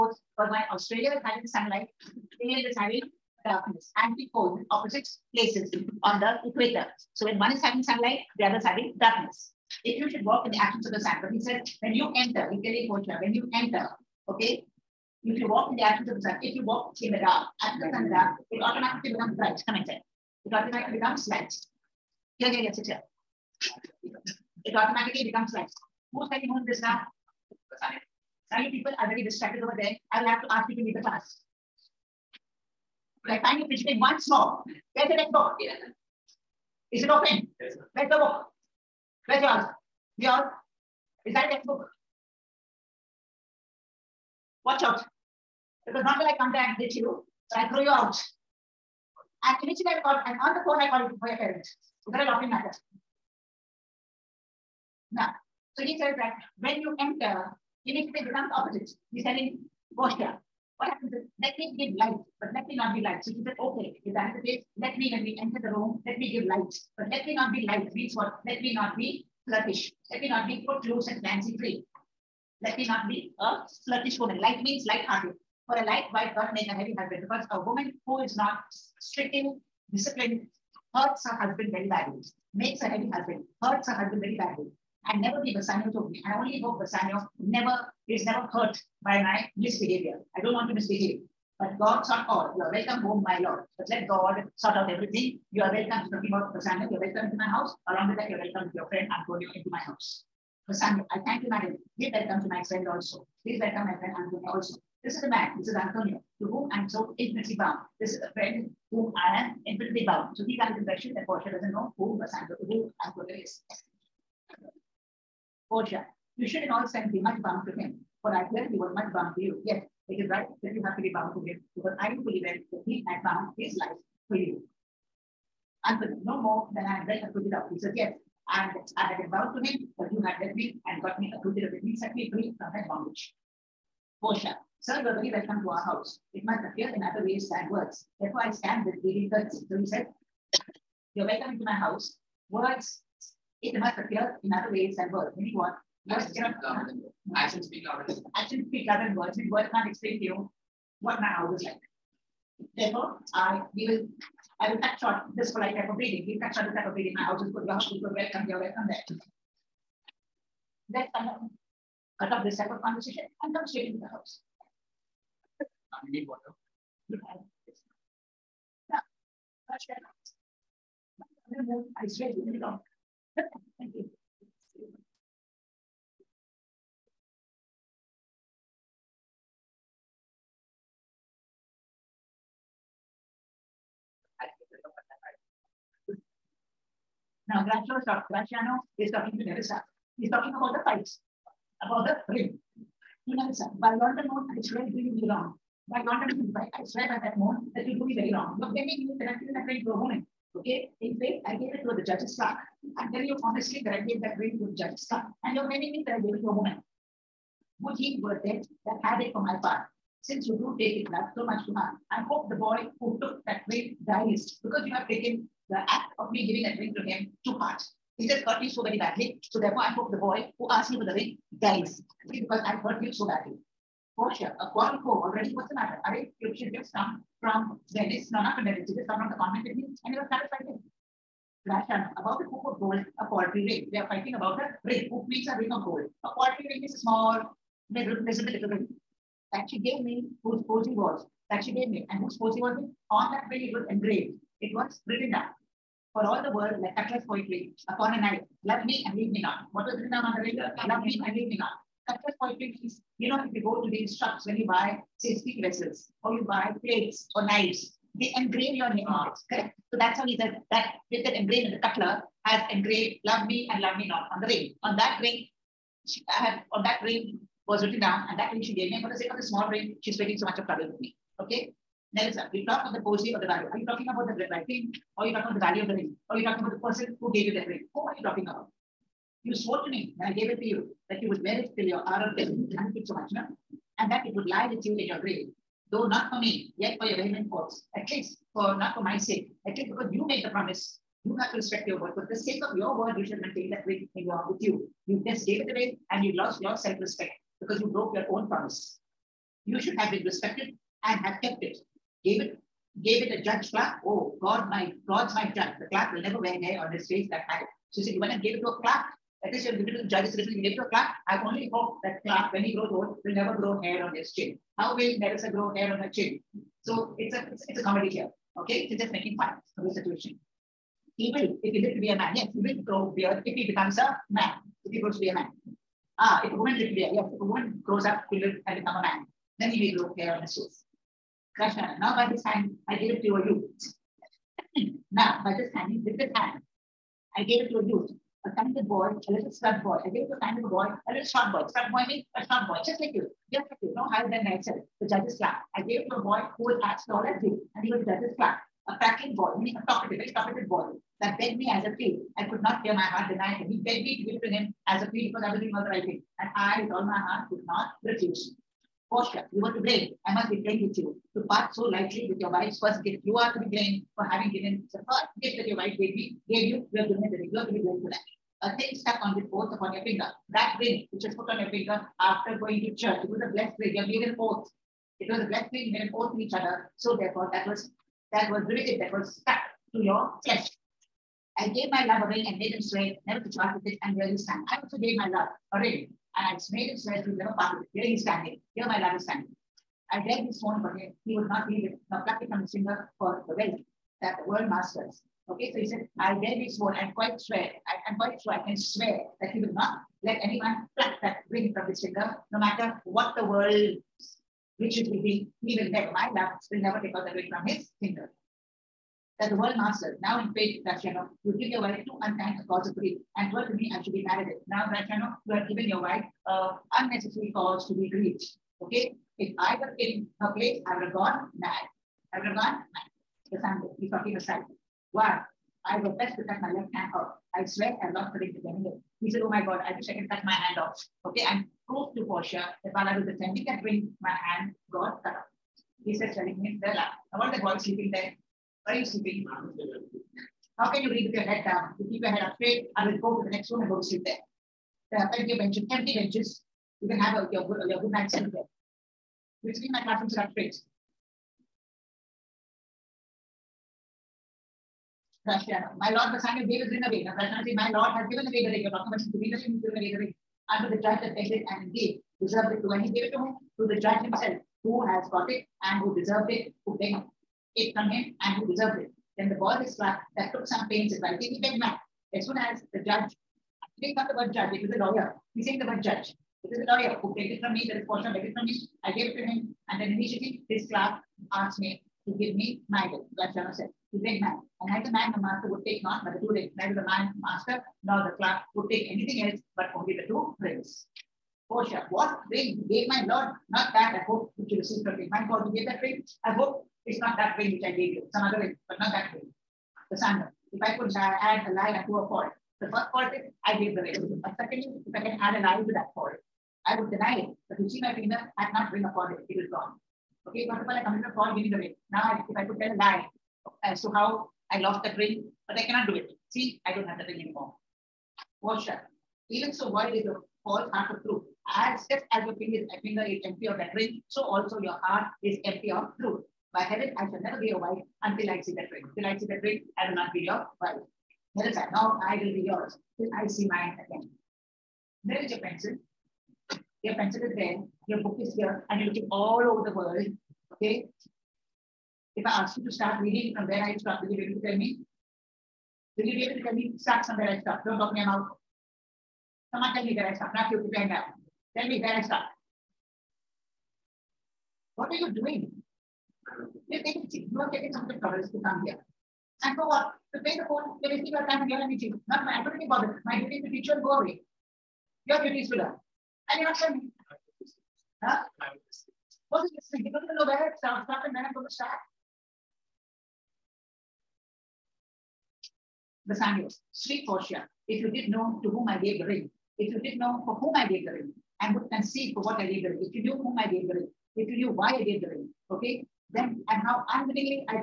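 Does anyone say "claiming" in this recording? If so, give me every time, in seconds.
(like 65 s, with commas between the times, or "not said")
205 s.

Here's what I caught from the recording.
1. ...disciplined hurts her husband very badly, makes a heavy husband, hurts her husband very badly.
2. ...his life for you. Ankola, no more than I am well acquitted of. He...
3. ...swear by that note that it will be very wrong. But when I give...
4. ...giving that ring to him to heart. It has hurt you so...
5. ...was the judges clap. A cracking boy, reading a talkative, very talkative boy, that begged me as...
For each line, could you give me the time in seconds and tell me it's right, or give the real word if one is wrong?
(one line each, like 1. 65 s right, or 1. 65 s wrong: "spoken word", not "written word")
1. 79 s right
2. 123 s right
3. 196 s right
4. 216 s right
5. 347 s wrong: "meaning", not "reading".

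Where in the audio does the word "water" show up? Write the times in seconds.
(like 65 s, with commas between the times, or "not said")
166 s.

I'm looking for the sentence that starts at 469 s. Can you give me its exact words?
Then the boy is struck that took some pains in writing, he begged mad.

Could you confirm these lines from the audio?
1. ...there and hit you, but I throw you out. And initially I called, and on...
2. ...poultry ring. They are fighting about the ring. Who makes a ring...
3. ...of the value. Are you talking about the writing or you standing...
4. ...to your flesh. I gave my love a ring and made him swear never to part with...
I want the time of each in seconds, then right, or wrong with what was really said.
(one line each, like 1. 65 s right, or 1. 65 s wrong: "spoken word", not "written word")
1. 46 s right
2. 233 s right
3. 273 s wrong: "talking", not "standing"
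4. 379 s right.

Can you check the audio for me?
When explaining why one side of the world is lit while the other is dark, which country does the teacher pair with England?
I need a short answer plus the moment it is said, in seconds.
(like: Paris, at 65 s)
Australia, at 0 s.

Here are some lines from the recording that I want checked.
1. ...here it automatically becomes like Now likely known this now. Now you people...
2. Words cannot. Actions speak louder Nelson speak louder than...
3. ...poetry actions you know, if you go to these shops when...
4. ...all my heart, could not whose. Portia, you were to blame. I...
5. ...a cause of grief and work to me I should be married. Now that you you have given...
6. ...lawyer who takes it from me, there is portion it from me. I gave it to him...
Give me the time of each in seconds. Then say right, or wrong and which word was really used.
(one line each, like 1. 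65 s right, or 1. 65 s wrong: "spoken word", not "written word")
1. 22 s wrong: "Most", not "Now"
2. 146 s wrong: "Actions", not "Nelson"
3. 252 s wrong: "means", not "actions"
4. 356 s wrong: "refuse", not "whose"
5. 412 s right
6. 476 s right.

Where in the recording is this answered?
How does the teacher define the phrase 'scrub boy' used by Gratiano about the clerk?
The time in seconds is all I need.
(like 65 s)
342 s.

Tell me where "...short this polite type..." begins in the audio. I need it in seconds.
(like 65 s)
154 s.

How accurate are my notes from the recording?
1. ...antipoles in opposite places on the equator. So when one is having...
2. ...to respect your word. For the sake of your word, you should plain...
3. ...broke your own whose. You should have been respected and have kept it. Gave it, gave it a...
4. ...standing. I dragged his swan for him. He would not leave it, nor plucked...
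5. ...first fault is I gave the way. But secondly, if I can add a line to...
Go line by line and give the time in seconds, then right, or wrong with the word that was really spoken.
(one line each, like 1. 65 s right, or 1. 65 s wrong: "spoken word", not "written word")
1. 3 s right
2. 291 s wrong: "maintain", not "plain"
3. 297 s wrong: "promise", not "whose"
4. 389 s right
5. 502 s right.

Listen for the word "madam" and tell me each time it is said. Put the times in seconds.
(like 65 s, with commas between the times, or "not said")
101 s.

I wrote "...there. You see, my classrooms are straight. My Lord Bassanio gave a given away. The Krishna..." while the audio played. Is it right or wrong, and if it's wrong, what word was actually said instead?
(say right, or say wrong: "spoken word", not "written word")
right.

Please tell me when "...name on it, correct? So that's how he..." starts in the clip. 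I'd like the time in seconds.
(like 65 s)
258 s.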